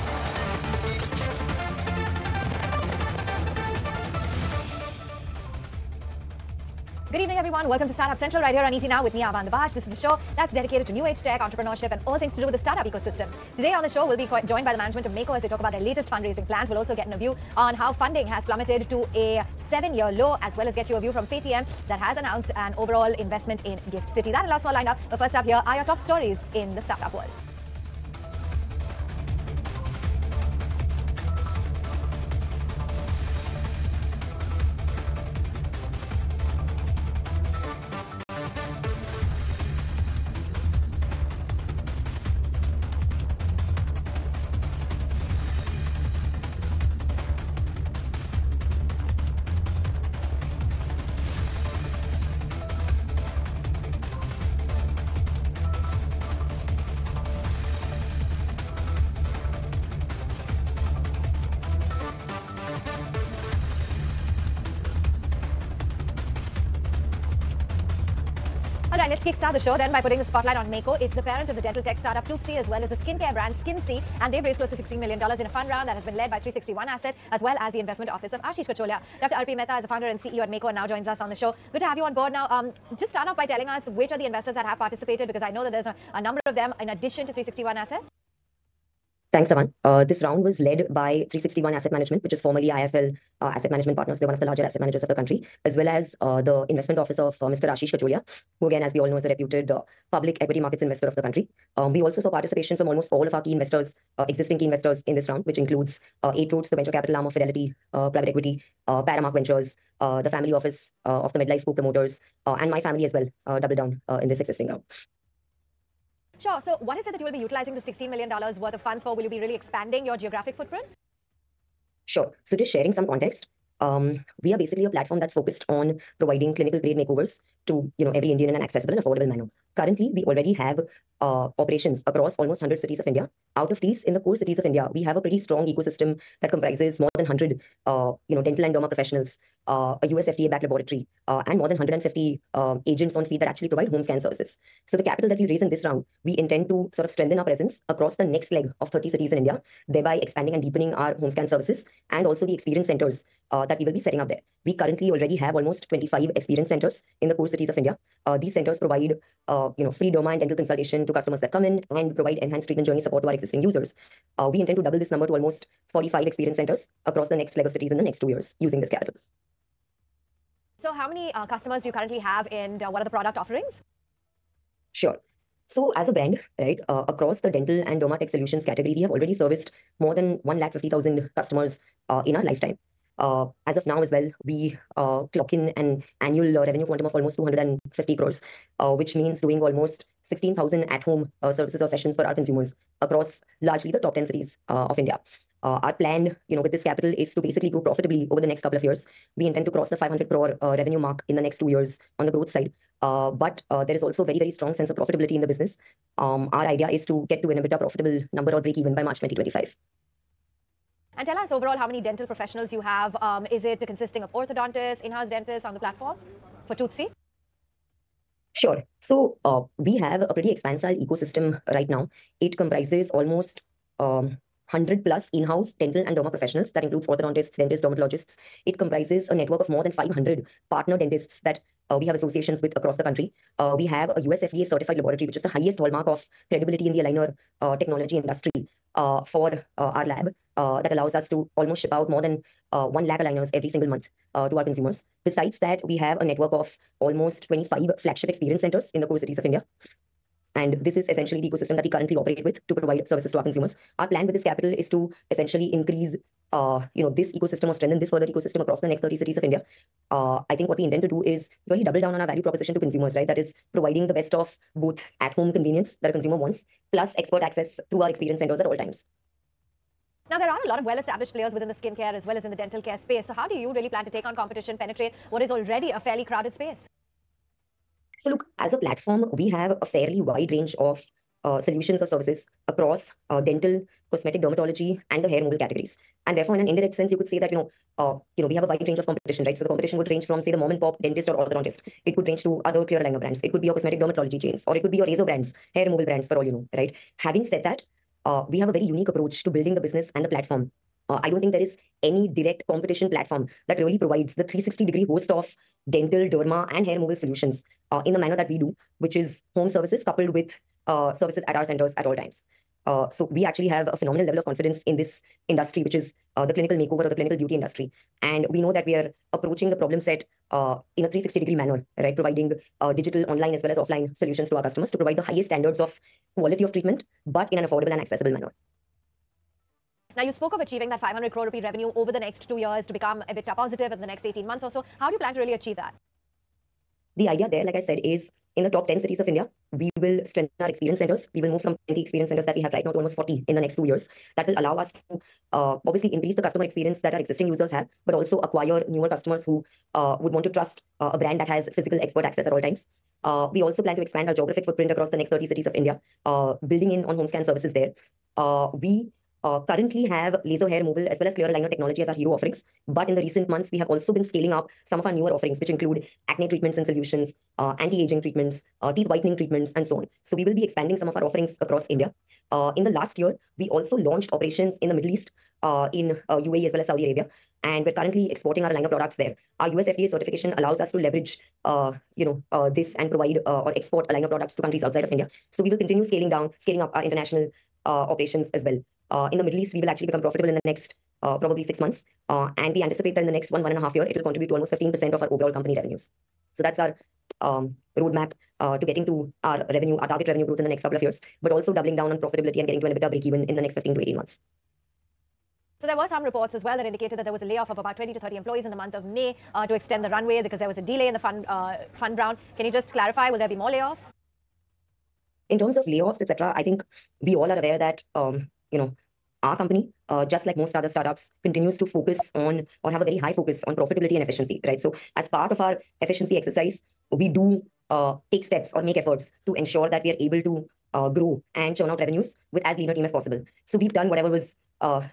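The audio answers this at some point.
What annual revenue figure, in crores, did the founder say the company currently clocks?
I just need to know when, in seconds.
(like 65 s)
187 s.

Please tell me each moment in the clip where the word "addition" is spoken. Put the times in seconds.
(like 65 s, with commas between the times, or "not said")
86 s.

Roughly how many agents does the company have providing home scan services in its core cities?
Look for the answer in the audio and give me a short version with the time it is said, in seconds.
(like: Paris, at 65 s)
150, at 141 s.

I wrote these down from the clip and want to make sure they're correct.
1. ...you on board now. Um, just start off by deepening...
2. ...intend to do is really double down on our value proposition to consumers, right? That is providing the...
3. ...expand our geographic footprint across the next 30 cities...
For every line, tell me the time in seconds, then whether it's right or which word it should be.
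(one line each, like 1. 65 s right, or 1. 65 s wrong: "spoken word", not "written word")
1. 81 s wrong: "telling", not "deepening"
2. 260 s right
3. 354 s right.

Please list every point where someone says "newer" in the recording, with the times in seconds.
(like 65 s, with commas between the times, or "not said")
348 s, 365 s.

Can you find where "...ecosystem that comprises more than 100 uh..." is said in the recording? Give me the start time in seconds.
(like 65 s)
135 s.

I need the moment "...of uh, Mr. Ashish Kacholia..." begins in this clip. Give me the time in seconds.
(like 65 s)
97 s.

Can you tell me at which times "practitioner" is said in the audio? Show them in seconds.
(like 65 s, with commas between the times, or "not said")
not said.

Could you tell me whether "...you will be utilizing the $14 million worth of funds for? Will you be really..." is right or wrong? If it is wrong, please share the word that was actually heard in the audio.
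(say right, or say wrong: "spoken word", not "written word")
wrong: "16", not "14".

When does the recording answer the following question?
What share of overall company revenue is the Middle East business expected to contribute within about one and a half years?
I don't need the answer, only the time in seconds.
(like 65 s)
394 s.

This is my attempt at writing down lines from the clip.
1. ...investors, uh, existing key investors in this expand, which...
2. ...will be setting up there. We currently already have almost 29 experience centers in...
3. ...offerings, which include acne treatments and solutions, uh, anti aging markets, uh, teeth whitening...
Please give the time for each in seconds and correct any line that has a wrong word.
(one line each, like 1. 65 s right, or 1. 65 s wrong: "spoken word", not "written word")
1. 103 s wrong: "round", not "expand"
2. 153 s wrong: "25", not "29"
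3. 365 s wrong: "treatments", not "markets".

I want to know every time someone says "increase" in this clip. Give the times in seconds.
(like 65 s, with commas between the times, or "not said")
255 s, 346 s.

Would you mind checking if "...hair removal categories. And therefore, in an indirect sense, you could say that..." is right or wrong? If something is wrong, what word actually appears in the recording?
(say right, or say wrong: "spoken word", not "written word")
right.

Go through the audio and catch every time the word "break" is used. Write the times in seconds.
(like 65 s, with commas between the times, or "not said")
208 s, 403 s.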